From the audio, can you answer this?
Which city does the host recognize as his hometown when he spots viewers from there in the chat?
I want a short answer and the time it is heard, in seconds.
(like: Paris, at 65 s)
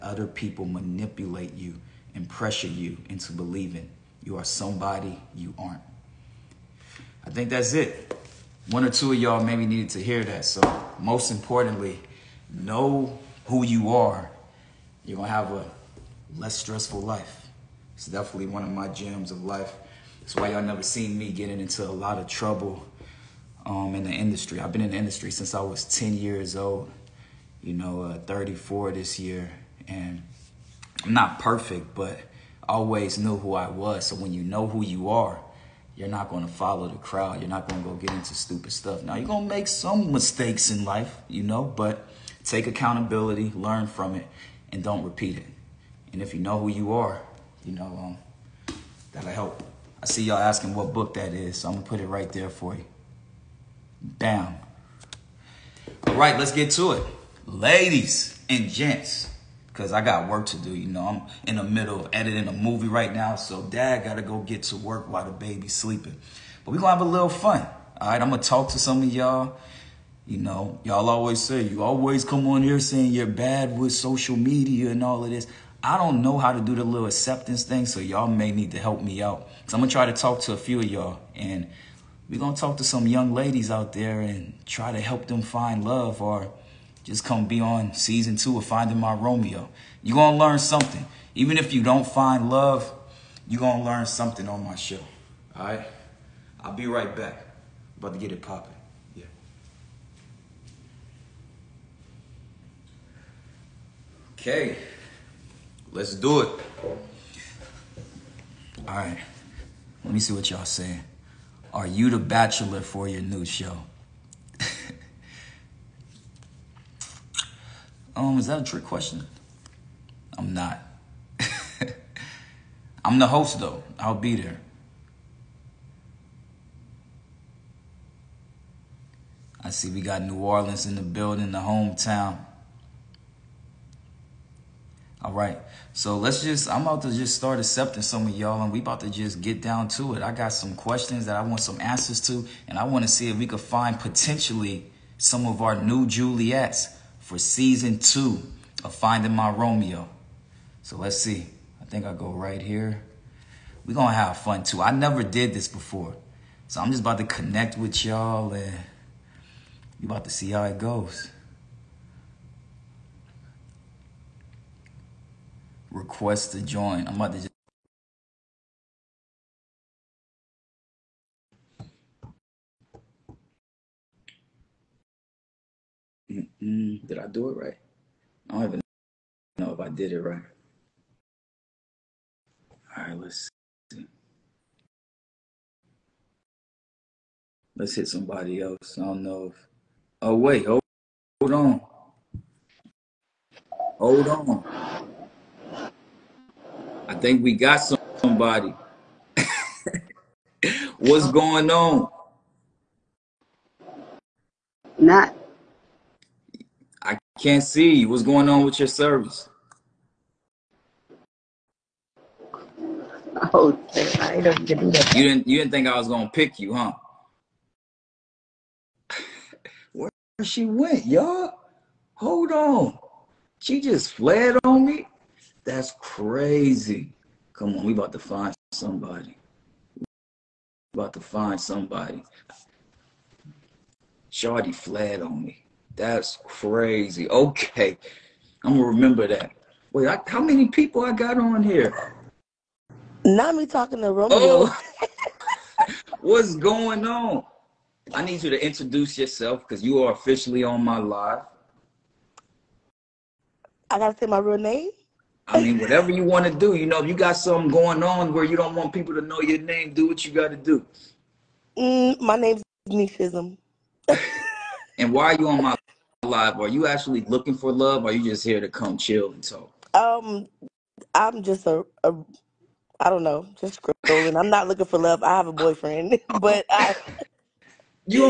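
New Orleans, at 130 s.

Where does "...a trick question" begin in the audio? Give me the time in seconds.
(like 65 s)
118 s.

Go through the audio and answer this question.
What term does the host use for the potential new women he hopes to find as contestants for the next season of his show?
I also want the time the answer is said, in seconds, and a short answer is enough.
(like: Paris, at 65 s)
Juliets, at 146 s.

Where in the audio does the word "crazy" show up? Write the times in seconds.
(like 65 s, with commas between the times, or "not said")
225 s, 236 s.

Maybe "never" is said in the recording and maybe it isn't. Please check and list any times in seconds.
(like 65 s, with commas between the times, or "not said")
20 s, 154 s.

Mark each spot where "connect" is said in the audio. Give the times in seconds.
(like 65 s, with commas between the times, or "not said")
157 s.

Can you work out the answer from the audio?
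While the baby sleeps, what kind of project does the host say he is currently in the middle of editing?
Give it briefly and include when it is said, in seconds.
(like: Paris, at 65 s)
movie, at 62 s.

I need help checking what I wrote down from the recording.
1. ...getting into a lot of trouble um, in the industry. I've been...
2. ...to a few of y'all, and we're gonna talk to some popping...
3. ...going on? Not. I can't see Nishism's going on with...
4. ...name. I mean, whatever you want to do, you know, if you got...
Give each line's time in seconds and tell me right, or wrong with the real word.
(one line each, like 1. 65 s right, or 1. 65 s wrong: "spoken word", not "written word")
1. 21 s right
2. 80 s wrong: "young", not "popping"
3. 201 s wrong: "What", not "Nishism"
4. 254 s right.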